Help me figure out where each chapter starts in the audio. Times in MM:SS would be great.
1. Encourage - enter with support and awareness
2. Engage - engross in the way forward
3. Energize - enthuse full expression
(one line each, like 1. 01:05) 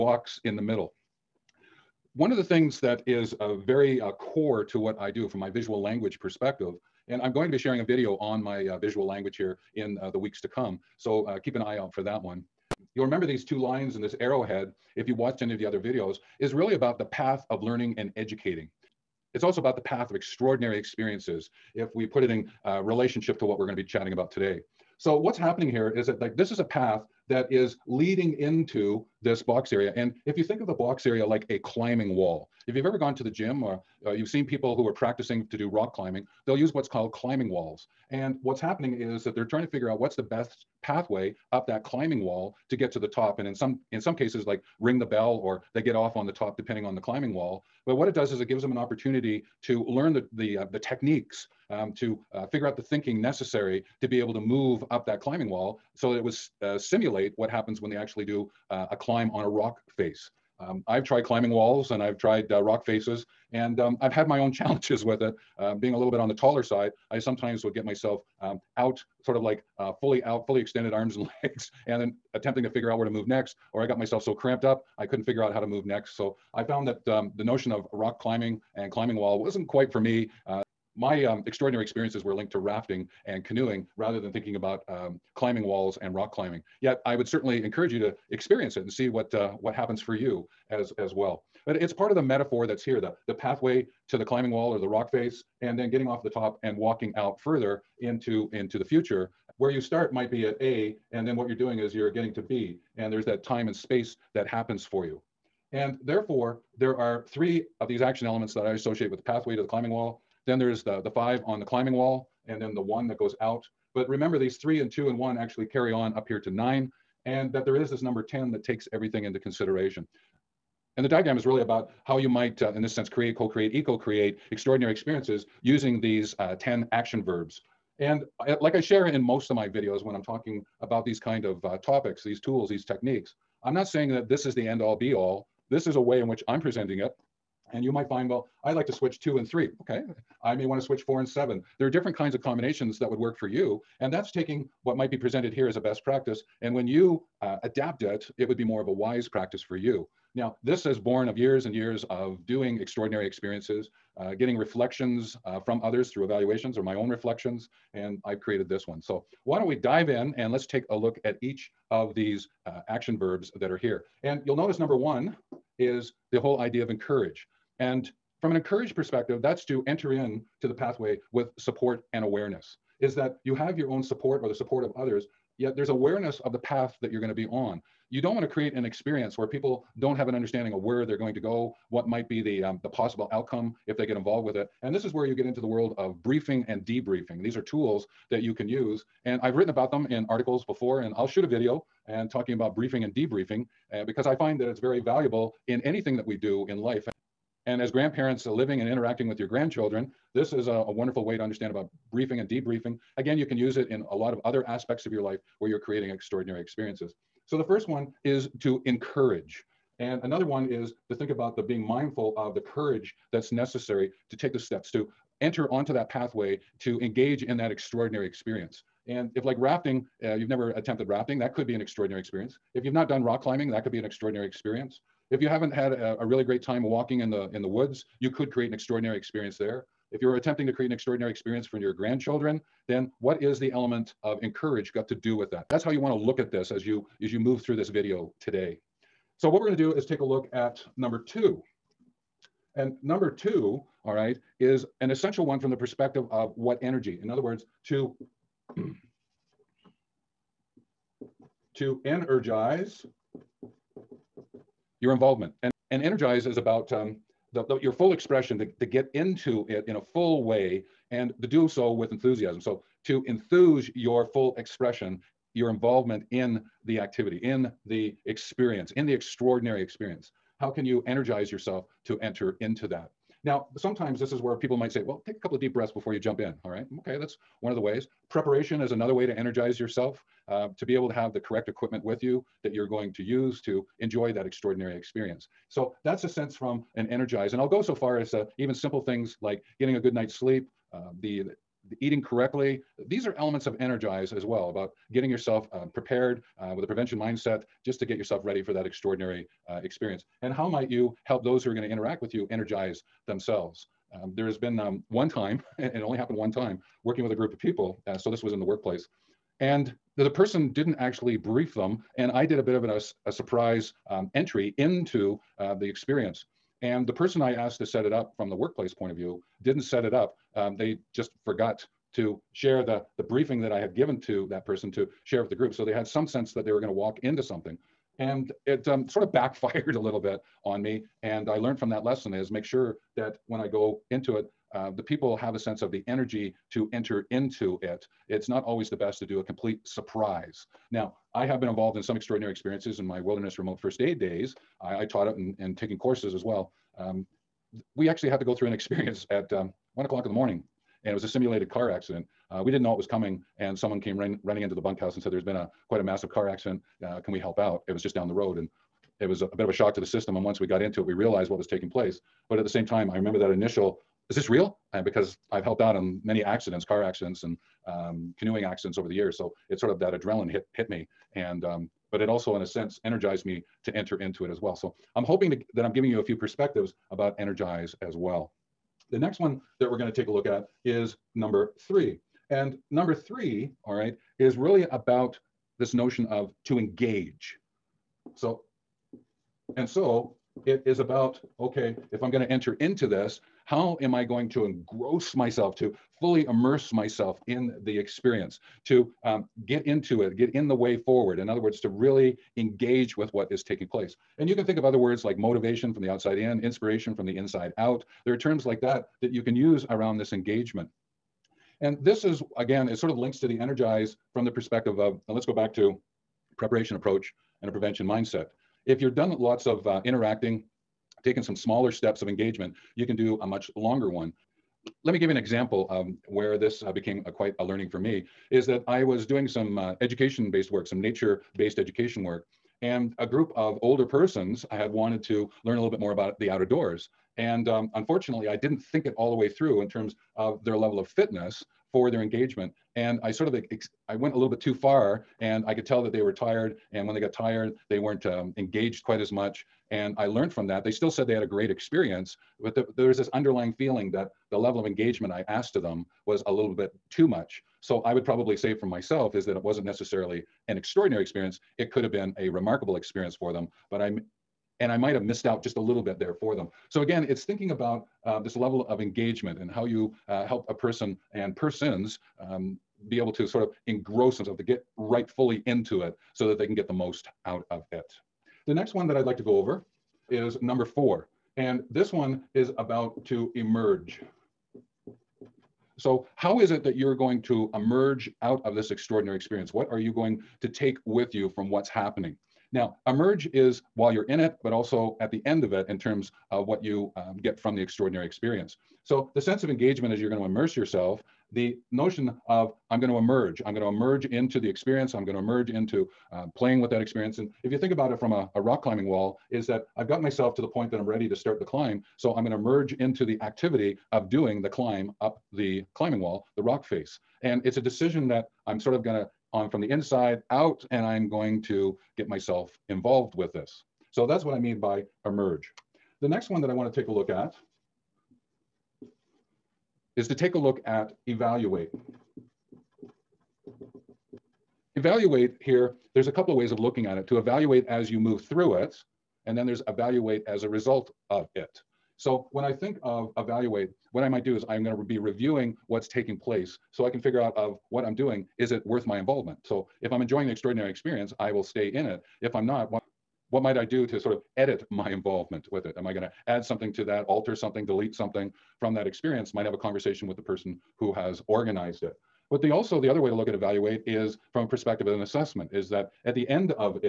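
1. 02:44
2. 06:22
3. 04:08.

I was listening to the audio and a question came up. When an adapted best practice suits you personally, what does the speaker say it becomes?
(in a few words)
Wise practice.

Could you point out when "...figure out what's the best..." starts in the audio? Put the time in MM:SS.
00:39.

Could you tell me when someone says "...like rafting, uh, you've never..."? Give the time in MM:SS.
03:39.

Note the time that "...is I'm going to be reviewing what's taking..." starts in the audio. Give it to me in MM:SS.
09:04.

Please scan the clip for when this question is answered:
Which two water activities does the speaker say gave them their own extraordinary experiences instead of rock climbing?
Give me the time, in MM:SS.
01:22.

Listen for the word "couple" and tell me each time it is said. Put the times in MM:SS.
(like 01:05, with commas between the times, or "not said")
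04:35, 08:56.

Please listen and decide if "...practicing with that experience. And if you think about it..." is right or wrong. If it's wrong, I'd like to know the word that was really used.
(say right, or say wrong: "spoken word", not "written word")
wrong: "playing", not "practicing".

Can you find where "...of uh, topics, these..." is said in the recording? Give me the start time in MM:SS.
02:11.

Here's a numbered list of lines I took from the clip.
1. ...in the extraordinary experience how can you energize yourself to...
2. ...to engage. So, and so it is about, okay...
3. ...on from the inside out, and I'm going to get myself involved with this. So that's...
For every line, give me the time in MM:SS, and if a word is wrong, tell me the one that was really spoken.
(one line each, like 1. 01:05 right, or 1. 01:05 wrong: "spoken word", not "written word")
1. 04:28 right
2. 06:26 right
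3. 08:39 right.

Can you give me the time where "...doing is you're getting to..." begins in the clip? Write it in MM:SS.
01:41.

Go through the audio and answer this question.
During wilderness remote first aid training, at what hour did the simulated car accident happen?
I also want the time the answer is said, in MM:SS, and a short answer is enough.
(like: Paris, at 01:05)
1 a.m., at 05:49.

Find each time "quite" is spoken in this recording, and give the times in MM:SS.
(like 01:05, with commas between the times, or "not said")
01:19, 05:55, 07:07, 07:29.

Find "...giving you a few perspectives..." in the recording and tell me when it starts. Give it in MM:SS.
06:15.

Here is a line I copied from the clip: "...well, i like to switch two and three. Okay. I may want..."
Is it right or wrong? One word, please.
right.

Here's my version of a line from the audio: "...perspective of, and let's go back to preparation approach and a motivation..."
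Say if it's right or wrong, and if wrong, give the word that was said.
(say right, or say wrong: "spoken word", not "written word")
wrong: "prevention", not "motivation".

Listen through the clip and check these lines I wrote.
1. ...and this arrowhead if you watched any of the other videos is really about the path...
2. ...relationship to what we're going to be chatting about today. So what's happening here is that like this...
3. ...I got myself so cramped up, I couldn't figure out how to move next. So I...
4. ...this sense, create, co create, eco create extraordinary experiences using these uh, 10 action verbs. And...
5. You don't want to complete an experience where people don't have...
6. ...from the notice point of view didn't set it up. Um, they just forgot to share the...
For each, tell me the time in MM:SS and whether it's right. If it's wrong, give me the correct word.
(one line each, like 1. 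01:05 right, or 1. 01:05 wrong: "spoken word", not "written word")
1. 00:13 right
2. 00:22 right
3. 01:13 right
4. 02:02 right
5. 02:58 wrong: "create", not "complete"
6. 05:18 wrong: "workplace", not "notice".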